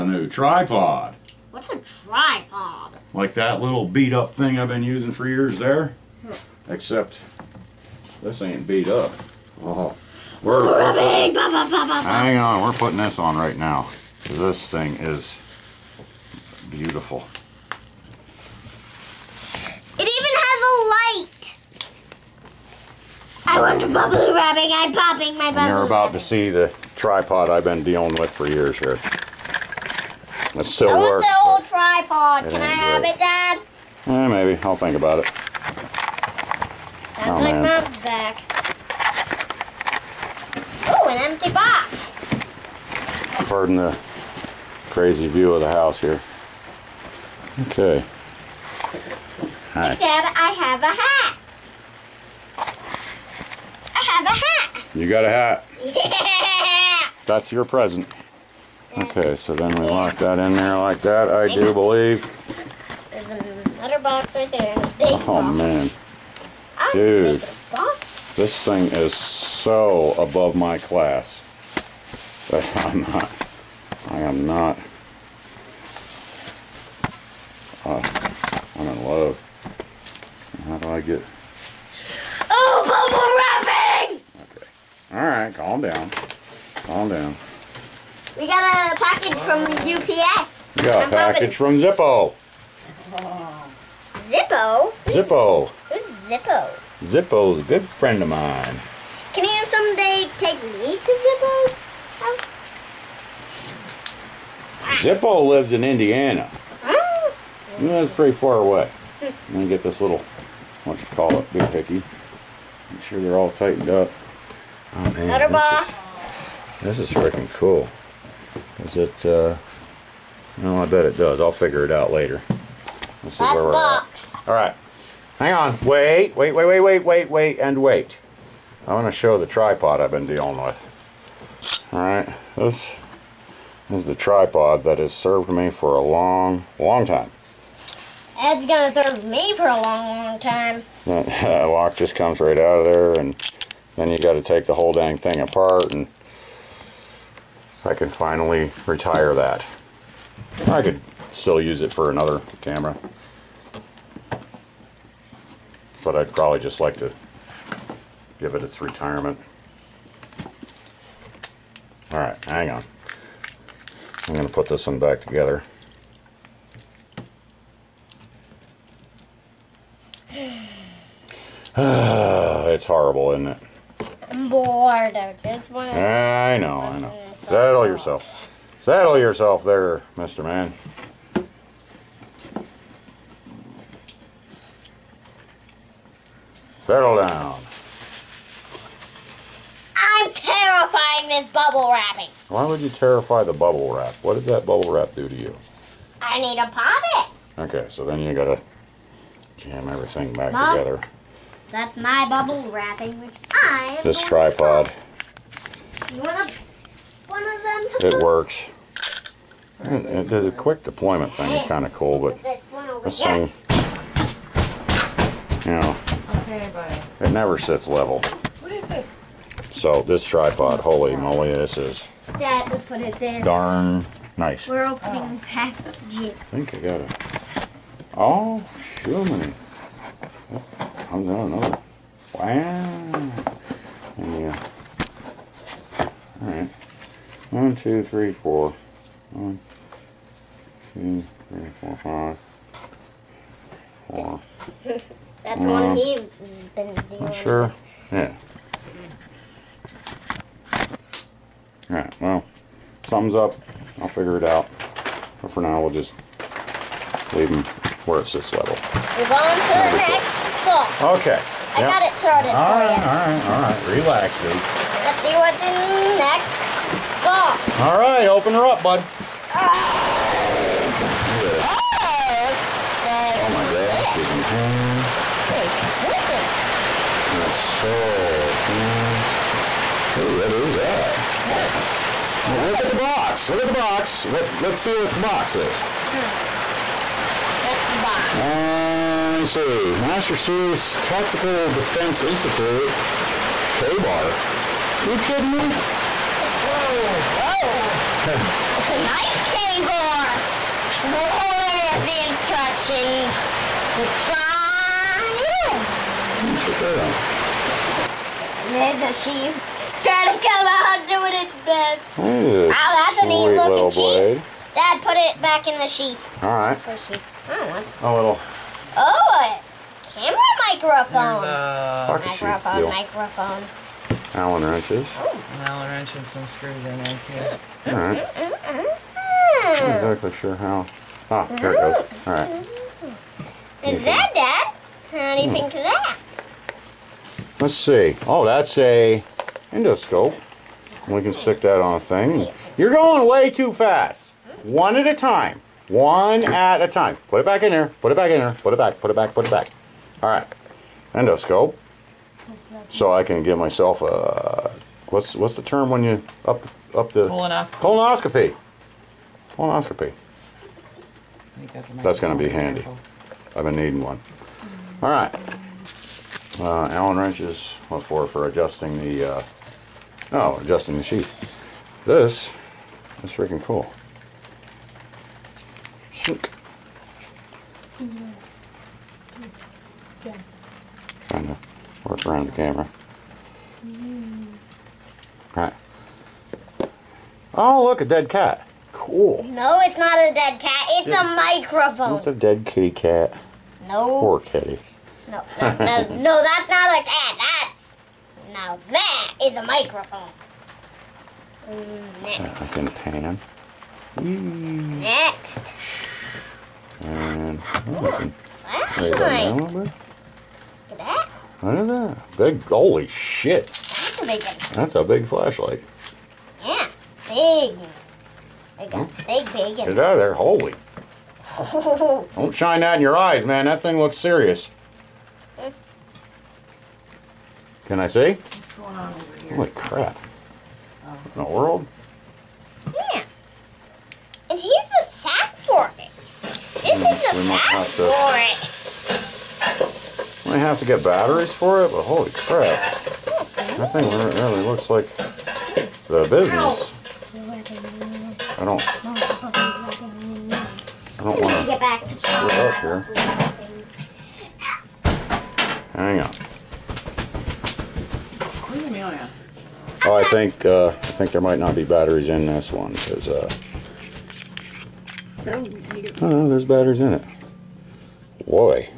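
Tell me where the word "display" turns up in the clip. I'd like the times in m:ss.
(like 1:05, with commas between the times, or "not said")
not said.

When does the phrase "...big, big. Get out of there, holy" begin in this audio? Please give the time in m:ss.
6:59.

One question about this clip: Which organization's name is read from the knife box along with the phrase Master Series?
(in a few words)
Tactical Defense Institute.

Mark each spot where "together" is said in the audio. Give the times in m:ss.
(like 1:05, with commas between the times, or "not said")
2:45, 3:20.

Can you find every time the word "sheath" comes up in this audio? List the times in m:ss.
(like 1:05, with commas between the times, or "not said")
5:15, 6:11.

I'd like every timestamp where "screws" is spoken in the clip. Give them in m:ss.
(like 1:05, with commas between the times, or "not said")
5:26, 7:32.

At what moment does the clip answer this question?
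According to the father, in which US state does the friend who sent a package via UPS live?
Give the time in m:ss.
1:45.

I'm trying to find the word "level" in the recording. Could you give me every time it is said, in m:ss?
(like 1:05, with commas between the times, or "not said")
3:37, 4:18.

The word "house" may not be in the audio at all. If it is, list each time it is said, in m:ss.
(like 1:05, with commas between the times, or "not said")
0:45, 1:42.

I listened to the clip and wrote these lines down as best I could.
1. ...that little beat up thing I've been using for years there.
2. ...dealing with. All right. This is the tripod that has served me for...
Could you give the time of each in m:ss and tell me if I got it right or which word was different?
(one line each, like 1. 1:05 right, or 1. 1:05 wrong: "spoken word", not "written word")
1. 0:03 right
2. 2:10 right.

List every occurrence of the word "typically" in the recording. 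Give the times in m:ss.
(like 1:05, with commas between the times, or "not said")
not said.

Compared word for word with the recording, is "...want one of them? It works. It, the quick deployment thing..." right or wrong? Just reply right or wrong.
right.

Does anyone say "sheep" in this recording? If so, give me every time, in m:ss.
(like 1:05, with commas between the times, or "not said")
5:09, 5:13.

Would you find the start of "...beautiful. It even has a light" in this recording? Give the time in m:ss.
0:16.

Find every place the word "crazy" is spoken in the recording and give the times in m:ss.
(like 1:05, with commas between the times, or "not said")
0:44.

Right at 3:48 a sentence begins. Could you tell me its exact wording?
Oh, sure, many comes out another.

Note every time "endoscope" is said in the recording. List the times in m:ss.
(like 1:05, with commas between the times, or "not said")
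5:39, 5:51.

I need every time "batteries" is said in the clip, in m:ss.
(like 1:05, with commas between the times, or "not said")
7:21, 7:41, 7:46.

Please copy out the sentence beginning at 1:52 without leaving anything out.
Make sure they're all tightened up.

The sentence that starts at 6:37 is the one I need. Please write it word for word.
That's now that is a microphone.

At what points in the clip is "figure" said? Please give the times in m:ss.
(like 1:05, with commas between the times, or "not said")
2:01, 4:14.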